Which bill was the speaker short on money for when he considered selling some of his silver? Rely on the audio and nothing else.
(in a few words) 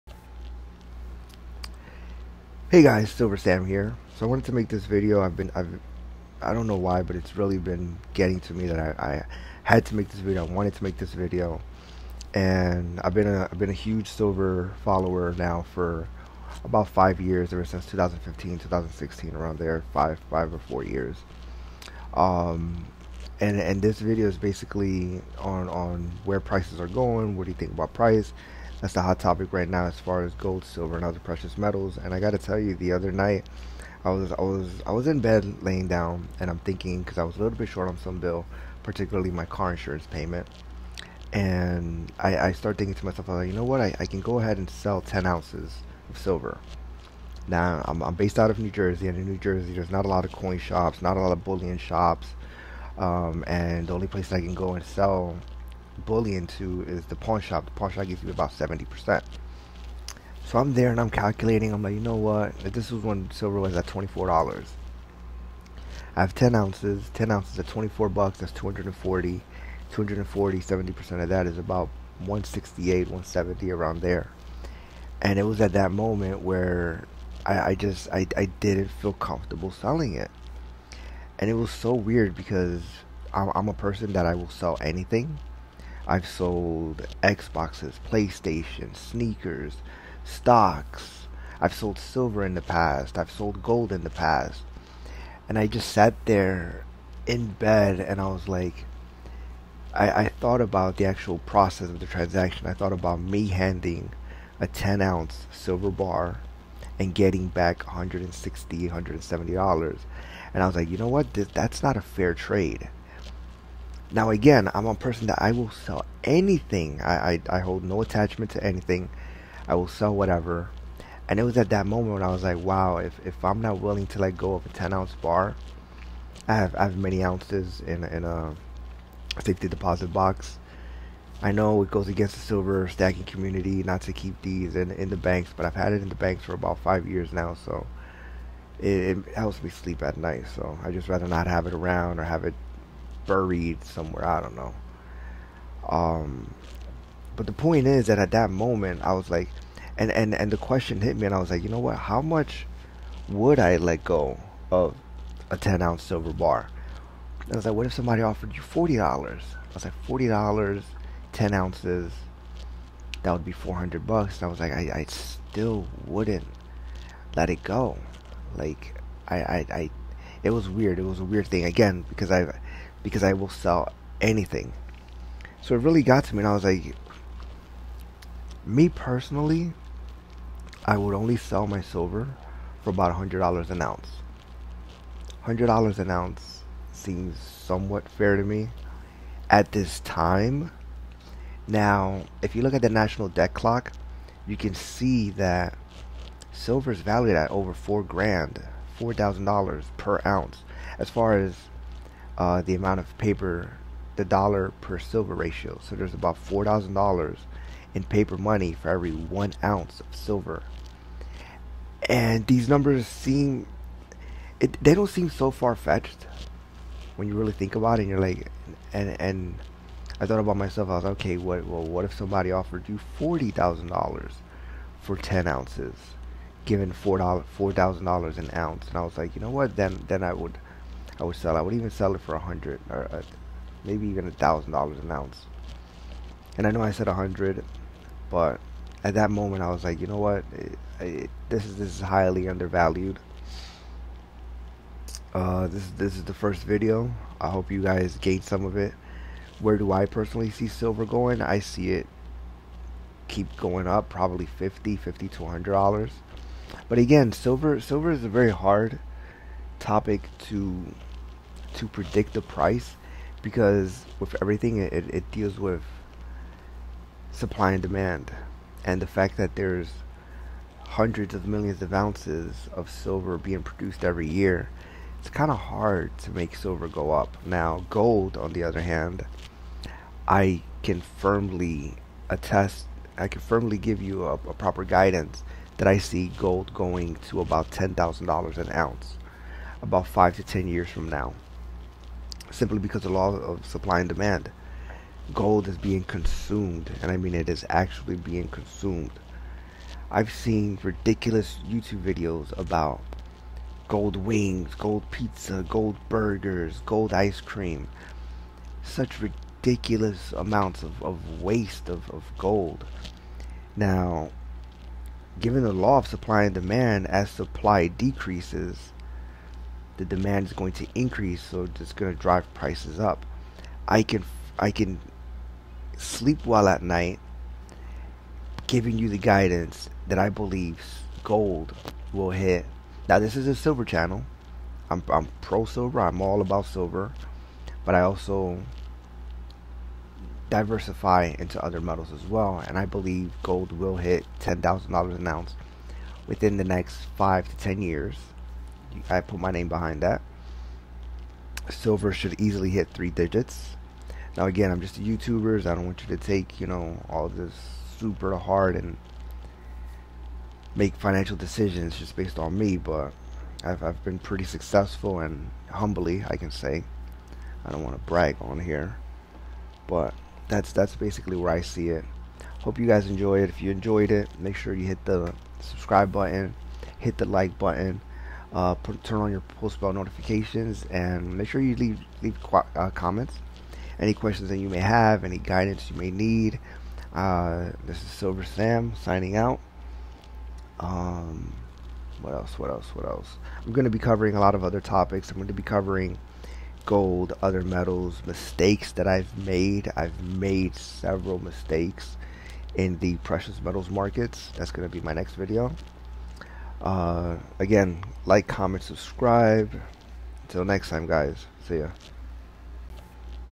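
Car insurance payment.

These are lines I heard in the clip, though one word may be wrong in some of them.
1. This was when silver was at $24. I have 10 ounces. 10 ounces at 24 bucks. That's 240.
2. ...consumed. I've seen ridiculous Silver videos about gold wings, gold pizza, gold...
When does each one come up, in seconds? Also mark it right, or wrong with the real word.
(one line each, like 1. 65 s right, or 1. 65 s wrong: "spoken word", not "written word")
1. 62 s right
2. 298 s wrong: "YouTube", not "Silver".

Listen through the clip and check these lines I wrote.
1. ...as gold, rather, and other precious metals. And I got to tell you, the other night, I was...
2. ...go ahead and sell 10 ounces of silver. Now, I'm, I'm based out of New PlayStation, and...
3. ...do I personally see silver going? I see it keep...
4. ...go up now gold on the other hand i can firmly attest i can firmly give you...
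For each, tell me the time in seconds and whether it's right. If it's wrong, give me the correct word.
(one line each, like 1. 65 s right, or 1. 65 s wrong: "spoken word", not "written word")
1. 30 s wrong: "silver", not "rather"
2. 44 s wrong: "Jersey", not "PlayStation"
3. 249 s right
4. 276 s right.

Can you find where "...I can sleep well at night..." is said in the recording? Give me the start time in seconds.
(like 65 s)
324 s.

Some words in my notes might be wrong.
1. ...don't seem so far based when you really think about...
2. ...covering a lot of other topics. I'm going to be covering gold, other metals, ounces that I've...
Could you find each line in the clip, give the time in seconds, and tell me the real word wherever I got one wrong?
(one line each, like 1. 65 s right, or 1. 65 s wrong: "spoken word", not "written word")
1. 214 s wrong: "fetched", not "based"
2. 393 s wrong: "mistakes", not "ounces".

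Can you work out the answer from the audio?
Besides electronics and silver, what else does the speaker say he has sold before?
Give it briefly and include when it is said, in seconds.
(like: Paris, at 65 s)
Sneakers, at 88 s.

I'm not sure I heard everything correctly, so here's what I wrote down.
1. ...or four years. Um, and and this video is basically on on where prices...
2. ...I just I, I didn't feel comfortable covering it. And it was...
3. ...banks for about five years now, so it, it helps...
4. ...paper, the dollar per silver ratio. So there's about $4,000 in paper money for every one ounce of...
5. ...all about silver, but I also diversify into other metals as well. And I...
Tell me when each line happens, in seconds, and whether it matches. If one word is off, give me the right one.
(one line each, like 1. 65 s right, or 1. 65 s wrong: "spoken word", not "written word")
1. 20 s right
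2. 77 s wrong: "selling", not "covering"
3. 136 s right
4. 203 s right
5. 336 s right.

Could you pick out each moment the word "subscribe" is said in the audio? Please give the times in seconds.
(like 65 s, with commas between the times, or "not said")
375 s, 408 s.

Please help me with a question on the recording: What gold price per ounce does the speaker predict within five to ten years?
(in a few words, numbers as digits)
$10,000.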